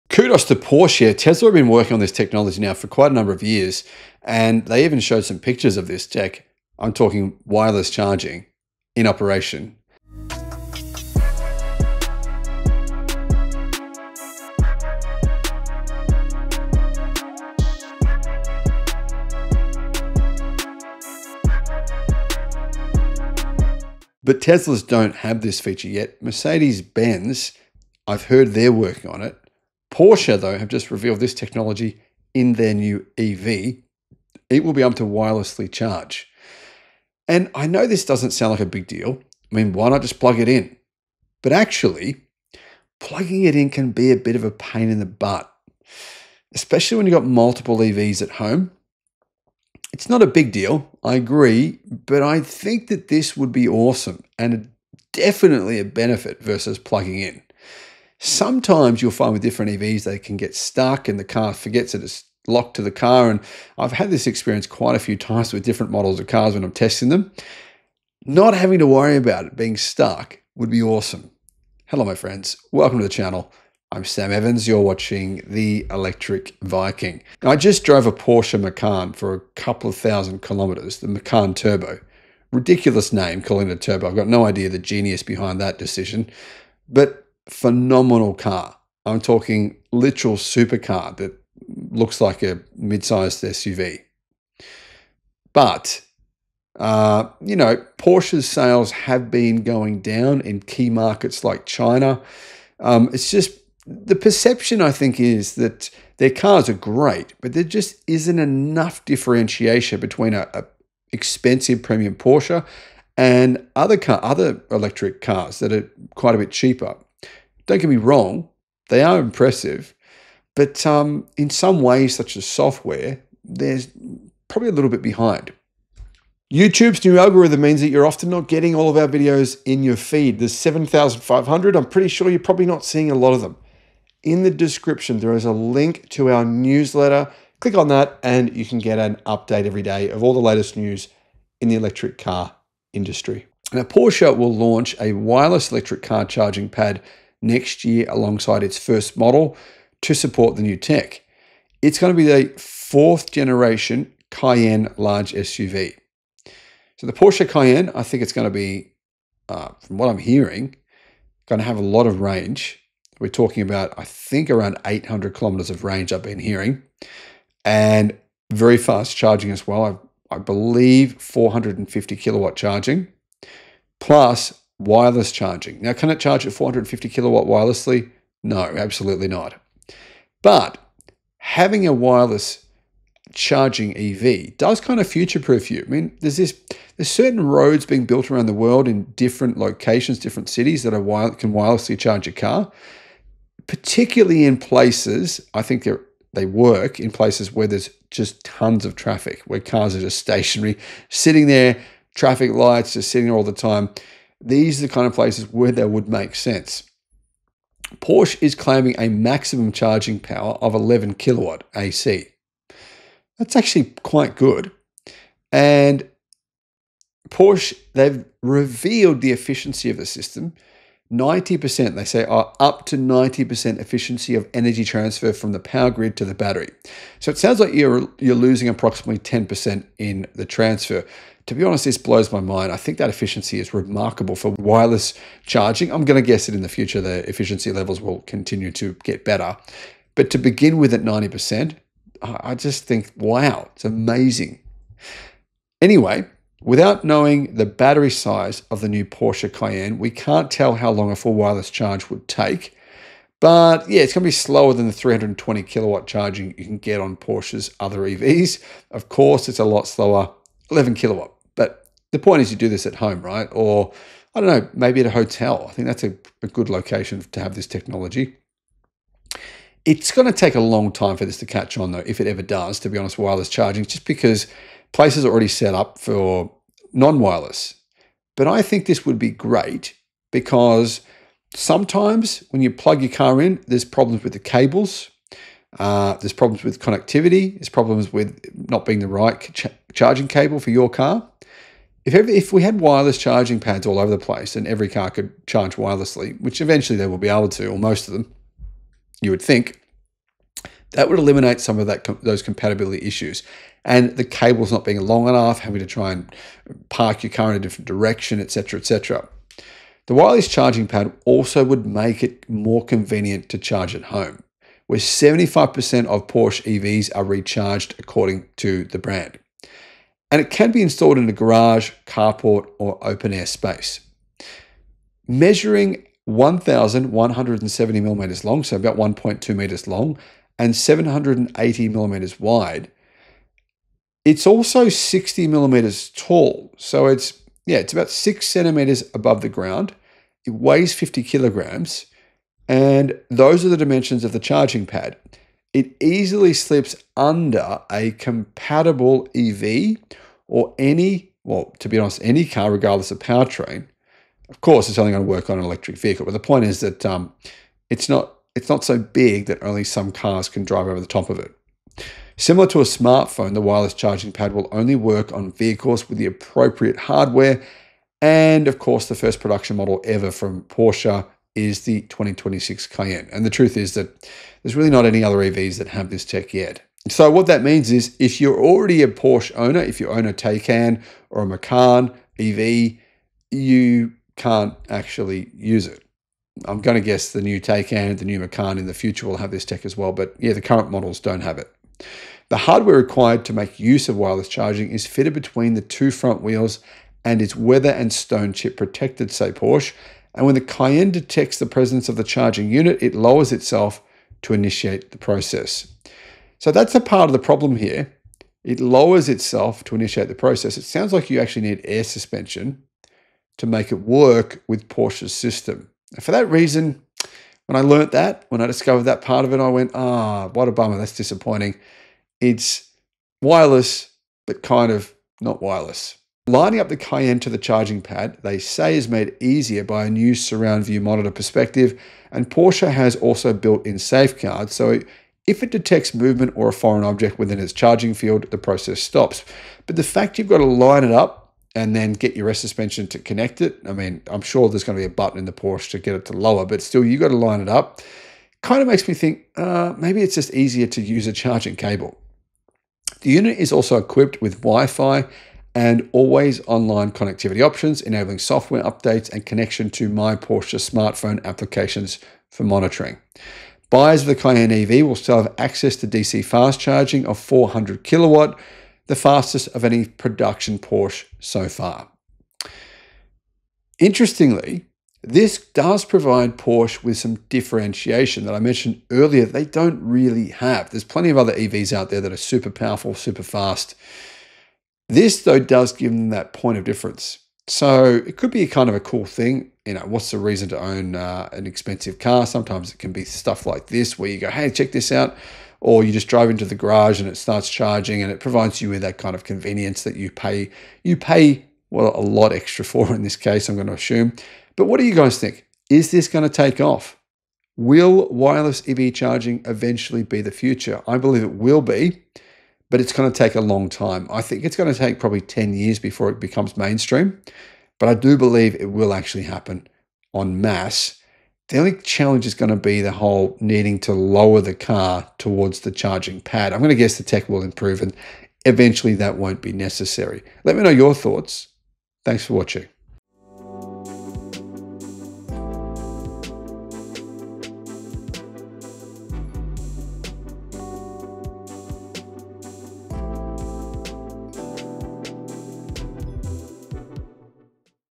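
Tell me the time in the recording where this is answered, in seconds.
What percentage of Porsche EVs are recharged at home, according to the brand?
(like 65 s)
314 s.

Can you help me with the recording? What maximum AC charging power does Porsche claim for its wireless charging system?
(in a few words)
11 kilowatts.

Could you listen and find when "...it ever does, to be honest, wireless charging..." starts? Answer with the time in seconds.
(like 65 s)
272 s.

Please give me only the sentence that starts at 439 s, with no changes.
But the fact you've got to line it up and then get your rest suspension to connect it.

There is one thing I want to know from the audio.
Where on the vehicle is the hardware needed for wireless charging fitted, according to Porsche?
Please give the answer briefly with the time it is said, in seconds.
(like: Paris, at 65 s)
between the two front wheels, at 395 s.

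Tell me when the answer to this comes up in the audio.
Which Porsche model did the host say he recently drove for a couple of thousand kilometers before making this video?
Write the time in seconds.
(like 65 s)
80 s.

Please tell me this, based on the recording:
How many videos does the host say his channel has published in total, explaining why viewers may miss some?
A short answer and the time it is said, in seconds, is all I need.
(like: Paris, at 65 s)
7,500, at 130 s.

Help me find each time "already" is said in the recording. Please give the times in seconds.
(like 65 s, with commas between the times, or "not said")
275 s, 378 s.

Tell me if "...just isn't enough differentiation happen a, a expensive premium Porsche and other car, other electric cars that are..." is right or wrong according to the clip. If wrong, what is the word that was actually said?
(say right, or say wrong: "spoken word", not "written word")
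wrong: "between", not "happen".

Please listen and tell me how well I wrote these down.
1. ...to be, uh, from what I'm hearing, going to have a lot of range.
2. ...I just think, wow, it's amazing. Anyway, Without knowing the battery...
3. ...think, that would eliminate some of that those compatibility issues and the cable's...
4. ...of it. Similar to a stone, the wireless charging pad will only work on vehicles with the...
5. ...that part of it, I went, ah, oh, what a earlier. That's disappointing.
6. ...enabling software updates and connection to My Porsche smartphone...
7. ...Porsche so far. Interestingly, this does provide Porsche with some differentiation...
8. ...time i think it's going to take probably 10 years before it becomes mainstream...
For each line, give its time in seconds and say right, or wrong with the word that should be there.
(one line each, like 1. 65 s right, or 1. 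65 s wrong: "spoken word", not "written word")
1. 158 s right
2. 242 s right
3. 299 s right
4. 361 s wrong: "smartphone", not "stone"
5. 419 s wrong: "bummer", not "earlier"
6. 458 s right
7. 470 s right
8. 513 s right.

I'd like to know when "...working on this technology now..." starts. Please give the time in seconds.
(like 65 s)
1 s.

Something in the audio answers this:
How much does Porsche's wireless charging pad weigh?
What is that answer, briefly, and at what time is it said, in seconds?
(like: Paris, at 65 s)
50 kilograms, at 340 s.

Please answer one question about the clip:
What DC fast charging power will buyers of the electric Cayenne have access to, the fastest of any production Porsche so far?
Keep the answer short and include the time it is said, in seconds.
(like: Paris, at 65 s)
400 kilowatts, at 467 s.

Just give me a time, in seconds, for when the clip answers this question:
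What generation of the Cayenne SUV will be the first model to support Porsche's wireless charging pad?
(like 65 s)
152 s.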